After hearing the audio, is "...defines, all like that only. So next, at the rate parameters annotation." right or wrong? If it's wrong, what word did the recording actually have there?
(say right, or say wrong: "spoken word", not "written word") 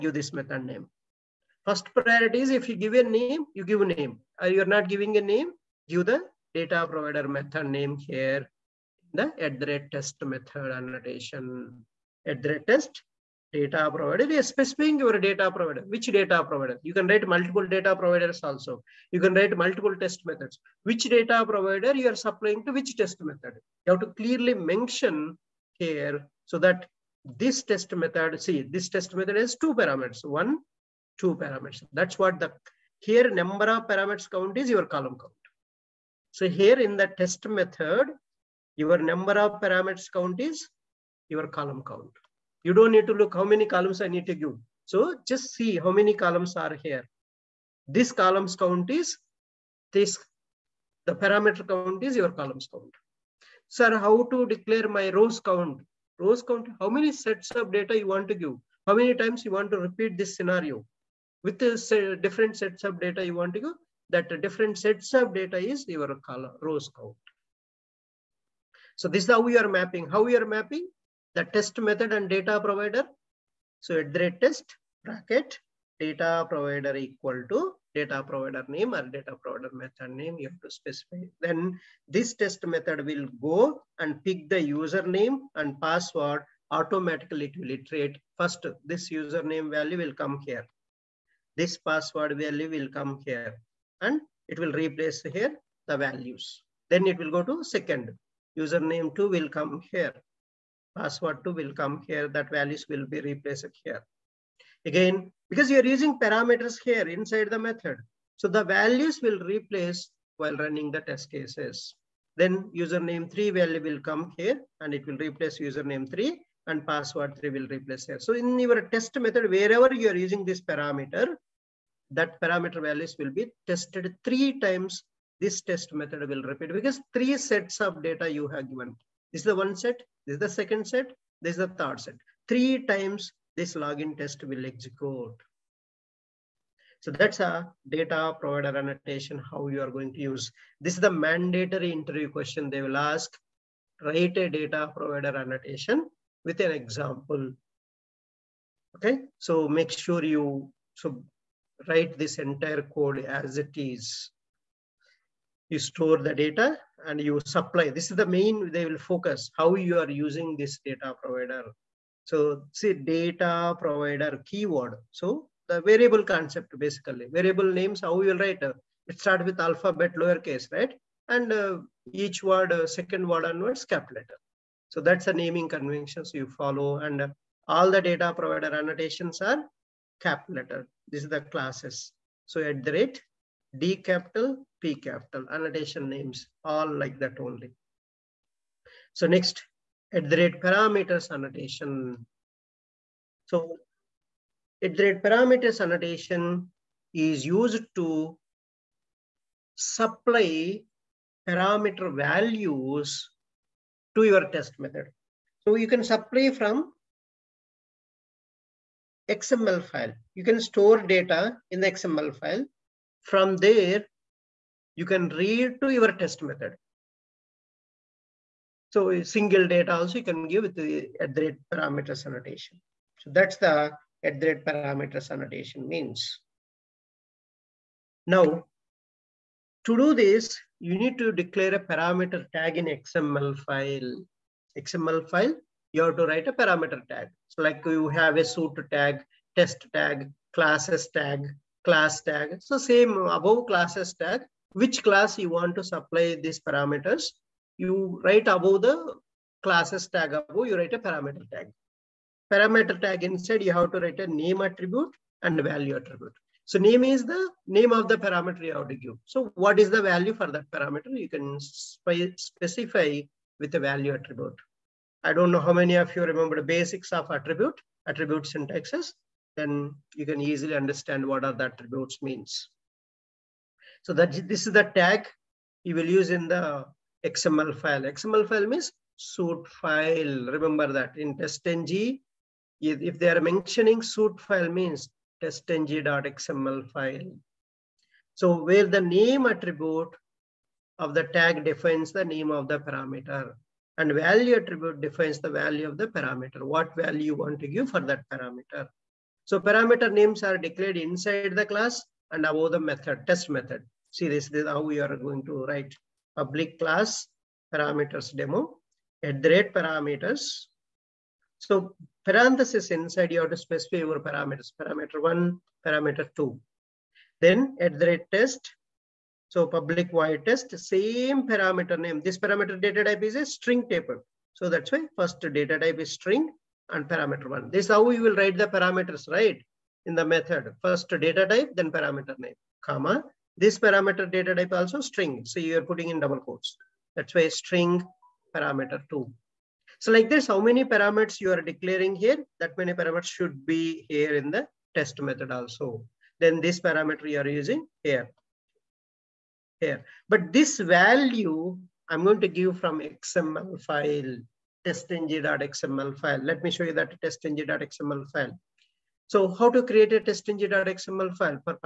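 wrong: "names", not "defines".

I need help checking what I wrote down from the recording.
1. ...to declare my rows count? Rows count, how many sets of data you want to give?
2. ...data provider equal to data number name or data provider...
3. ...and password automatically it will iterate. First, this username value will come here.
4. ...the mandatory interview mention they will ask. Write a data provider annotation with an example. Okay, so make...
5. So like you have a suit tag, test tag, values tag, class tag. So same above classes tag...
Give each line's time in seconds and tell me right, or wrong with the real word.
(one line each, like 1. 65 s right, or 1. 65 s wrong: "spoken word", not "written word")
1. 54 s right
2. 75 s wrong: "provider", not "number"
3. 85 s right
4. 140 s wrong: "question", not "mention"
5. 237 s wrong: "classes", not "values".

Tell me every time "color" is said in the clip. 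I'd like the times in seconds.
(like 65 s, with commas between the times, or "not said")
66 s.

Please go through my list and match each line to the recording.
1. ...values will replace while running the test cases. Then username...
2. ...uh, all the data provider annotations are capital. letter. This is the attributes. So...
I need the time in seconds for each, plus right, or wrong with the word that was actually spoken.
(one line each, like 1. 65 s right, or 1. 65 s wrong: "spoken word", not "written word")
1. 108 s right
2. 177 s wrong: "classes", not "attributes".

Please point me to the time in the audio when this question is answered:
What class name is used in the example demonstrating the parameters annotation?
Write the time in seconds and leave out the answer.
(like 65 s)
307 s.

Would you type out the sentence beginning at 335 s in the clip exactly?
So you are putting in double quotes.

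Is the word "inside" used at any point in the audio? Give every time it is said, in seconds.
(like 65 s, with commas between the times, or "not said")
107 s, 253 s, 300 s, 312 s.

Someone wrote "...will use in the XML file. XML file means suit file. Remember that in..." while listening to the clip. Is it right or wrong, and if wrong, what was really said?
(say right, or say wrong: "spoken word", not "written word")
right.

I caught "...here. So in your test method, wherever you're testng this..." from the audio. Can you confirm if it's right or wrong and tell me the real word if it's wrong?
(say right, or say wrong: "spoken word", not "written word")
wrong: "using", not "testng".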